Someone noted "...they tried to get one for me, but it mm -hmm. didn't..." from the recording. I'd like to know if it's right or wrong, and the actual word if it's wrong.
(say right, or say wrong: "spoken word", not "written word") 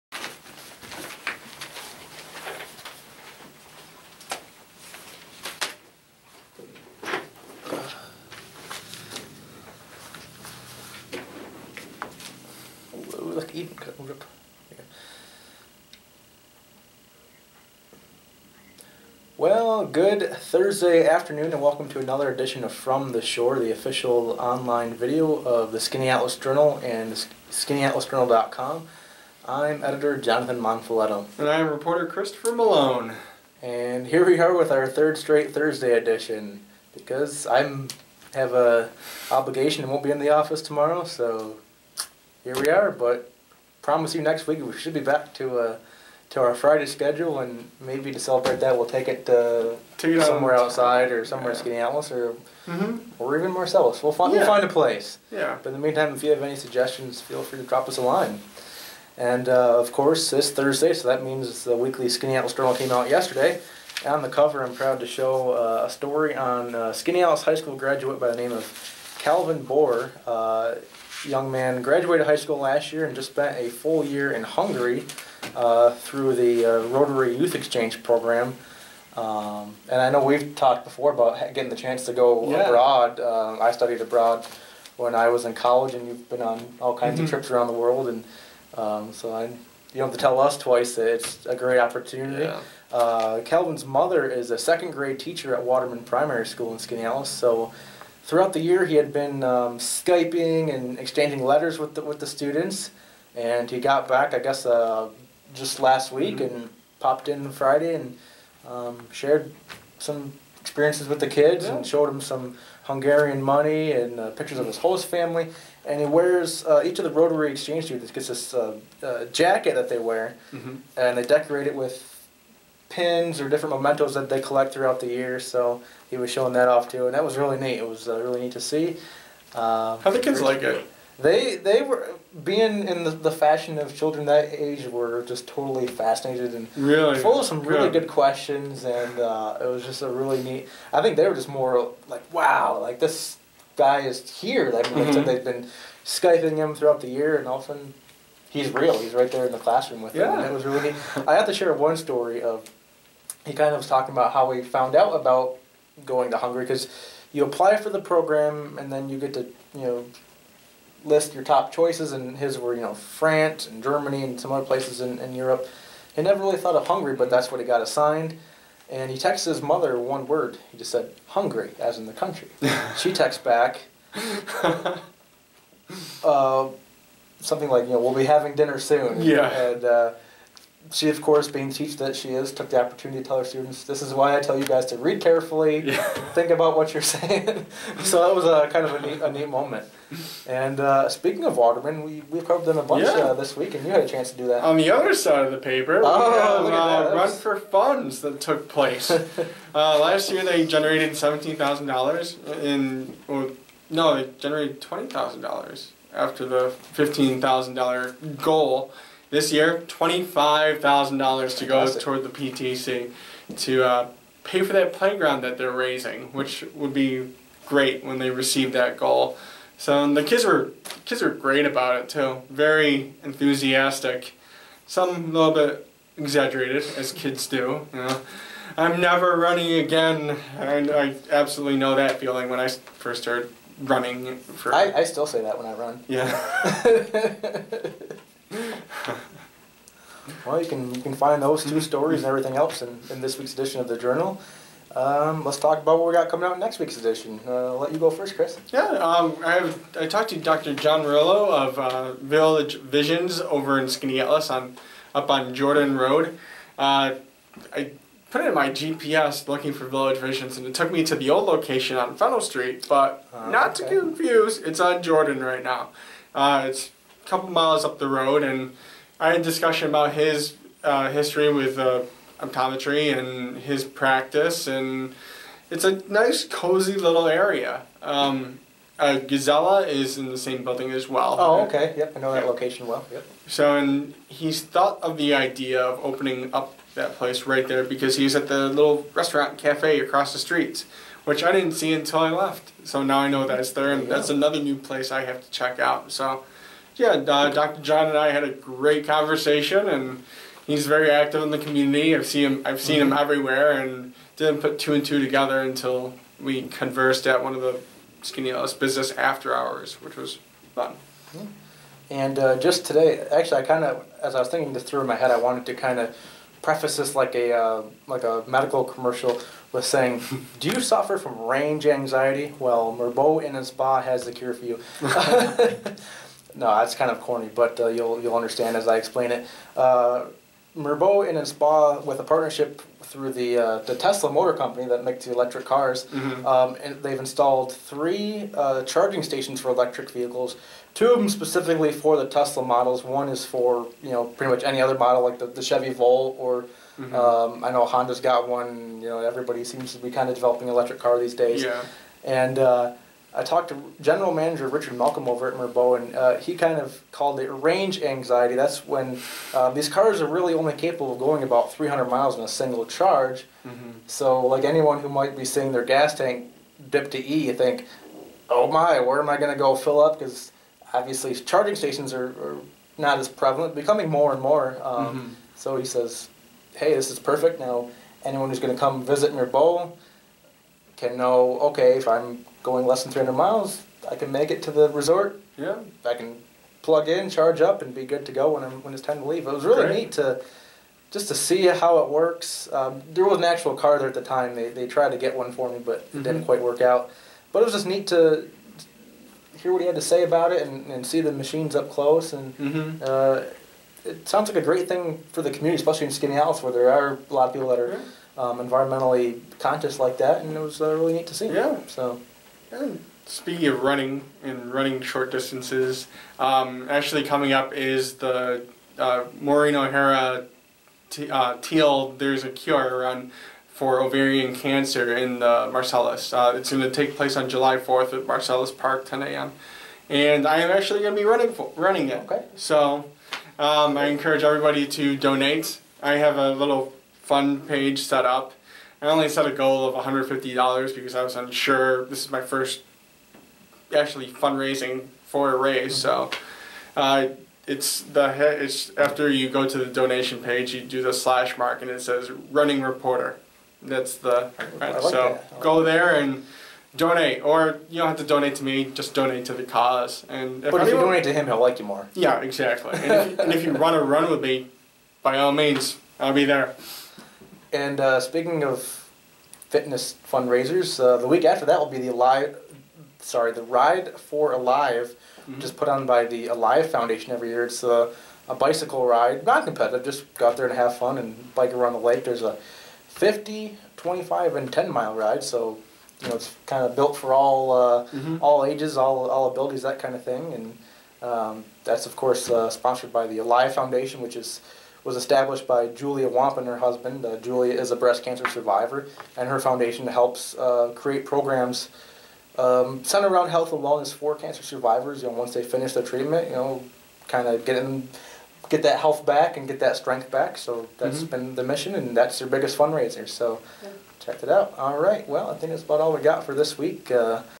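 right.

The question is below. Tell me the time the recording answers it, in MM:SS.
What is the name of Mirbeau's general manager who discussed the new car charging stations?
05:54.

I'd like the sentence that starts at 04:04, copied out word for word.
Um, let's talk about what we got coming out in next week's edition.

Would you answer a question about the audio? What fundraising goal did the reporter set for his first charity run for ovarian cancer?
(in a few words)
$150.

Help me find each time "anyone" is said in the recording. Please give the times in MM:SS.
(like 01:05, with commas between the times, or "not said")
06:04, 06:18.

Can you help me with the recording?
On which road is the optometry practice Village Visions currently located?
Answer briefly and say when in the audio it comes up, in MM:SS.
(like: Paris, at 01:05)
Jordan Road, at 04:15.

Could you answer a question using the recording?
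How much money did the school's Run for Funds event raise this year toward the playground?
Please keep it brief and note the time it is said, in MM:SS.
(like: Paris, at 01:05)
$25,000, at 03:29.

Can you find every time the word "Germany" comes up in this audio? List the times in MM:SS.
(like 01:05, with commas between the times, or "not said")
02:43.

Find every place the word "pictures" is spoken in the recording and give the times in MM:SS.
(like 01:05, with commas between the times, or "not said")
01:54.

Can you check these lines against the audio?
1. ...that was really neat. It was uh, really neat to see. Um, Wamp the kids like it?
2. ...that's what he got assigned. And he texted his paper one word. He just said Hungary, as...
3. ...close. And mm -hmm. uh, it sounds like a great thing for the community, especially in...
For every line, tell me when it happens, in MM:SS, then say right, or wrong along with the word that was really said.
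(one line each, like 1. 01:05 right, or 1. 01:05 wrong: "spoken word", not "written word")
1. 02:07 wrong: "How", not "Wamp"
2. 02:47 wrong: "mother", not "paper"
3. 06:41 right.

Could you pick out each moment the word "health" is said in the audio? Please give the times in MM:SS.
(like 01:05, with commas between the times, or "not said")
08:23, 08:28.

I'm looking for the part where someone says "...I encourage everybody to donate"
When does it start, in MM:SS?
07:13.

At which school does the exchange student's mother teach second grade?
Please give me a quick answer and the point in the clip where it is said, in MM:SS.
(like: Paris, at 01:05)
Waterman Primary School, at 01:35.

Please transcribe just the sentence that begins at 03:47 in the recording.
You know, I'm never running again, and I absolutely know that feeling when I first started running.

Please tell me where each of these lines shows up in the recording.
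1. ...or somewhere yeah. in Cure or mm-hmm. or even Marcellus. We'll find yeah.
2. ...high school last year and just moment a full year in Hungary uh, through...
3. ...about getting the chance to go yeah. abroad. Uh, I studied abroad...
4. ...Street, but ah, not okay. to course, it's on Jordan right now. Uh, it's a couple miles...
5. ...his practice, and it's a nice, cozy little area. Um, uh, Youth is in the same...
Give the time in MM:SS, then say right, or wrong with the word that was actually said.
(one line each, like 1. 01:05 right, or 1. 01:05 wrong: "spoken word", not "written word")
1. 00:51 wrong: "Indianapolis", not "Cure"
2. 01:12 wrong: "spent", not "moment"
3. 01:21 right
4. 04:22 wrong: "confuse", not "course"
5. 04:33 wrong: "Gazella", not "Youth".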